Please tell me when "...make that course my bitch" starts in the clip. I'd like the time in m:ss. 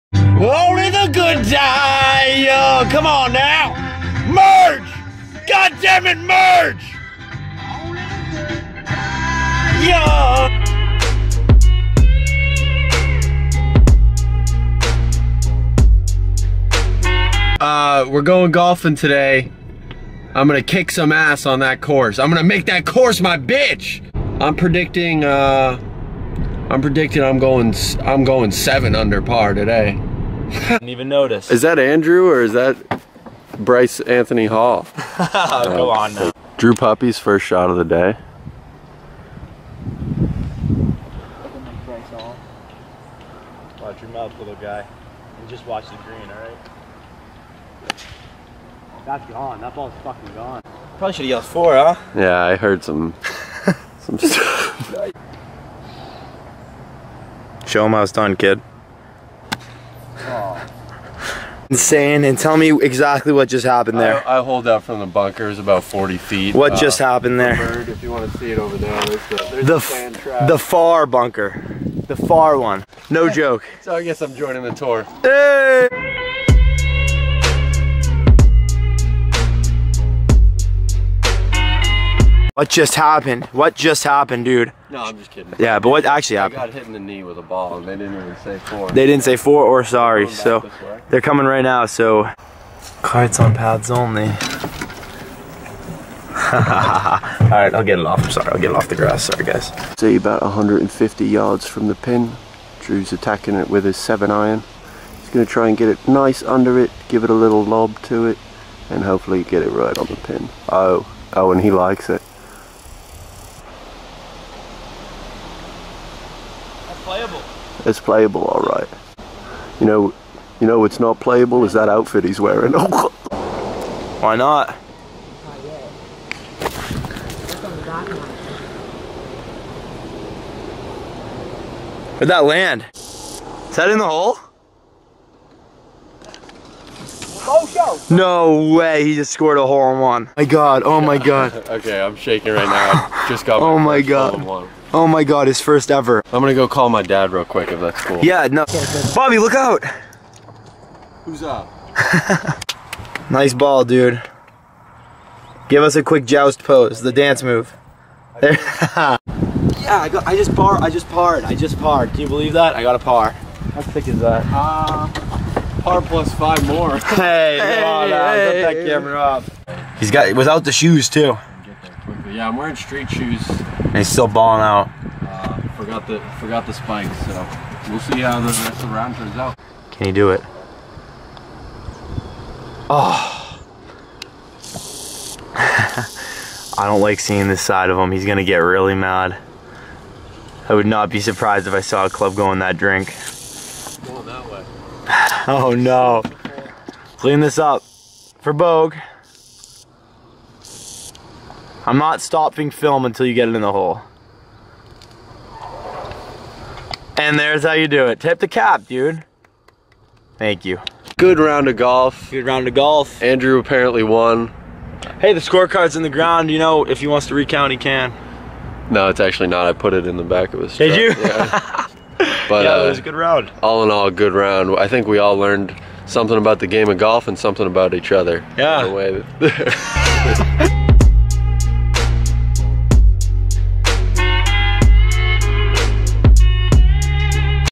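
0:22.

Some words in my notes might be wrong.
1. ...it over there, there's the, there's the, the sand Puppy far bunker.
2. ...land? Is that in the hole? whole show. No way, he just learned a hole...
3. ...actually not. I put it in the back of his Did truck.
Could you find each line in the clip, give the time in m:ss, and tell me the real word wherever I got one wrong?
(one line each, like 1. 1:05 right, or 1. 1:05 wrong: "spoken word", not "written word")
1. 1:08 wrong: "The", not "Puppy"
2. 2:12 wrong: "scored", not "learned"
3. 3:39 right.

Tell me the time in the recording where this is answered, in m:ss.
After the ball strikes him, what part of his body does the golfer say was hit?
1:26.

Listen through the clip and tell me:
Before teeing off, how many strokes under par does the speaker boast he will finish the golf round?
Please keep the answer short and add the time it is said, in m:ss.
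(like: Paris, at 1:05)
7, at 0:28.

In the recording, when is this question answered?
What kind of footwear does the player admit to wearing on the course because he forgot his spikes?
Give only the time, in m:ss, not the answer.
2:52.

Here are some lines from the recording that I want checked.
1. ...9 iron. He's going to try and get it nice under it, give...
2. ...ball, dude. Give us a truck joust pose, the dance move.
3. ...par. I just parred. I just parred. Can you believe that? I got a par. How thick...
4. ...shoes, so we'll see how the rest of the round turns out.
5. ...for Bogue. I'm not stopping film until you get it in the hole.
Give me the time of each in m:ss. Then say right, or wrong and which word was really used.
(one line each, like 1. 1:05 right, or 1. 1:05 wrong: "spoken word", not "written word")
1. 1:43 wrong: "7", not "9"
2. 2:33 wrong: "quick", not "truck"
3. 2:40 right
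4. 2:56 wrong: "spikes", not "shoes"
5. 3:18 right.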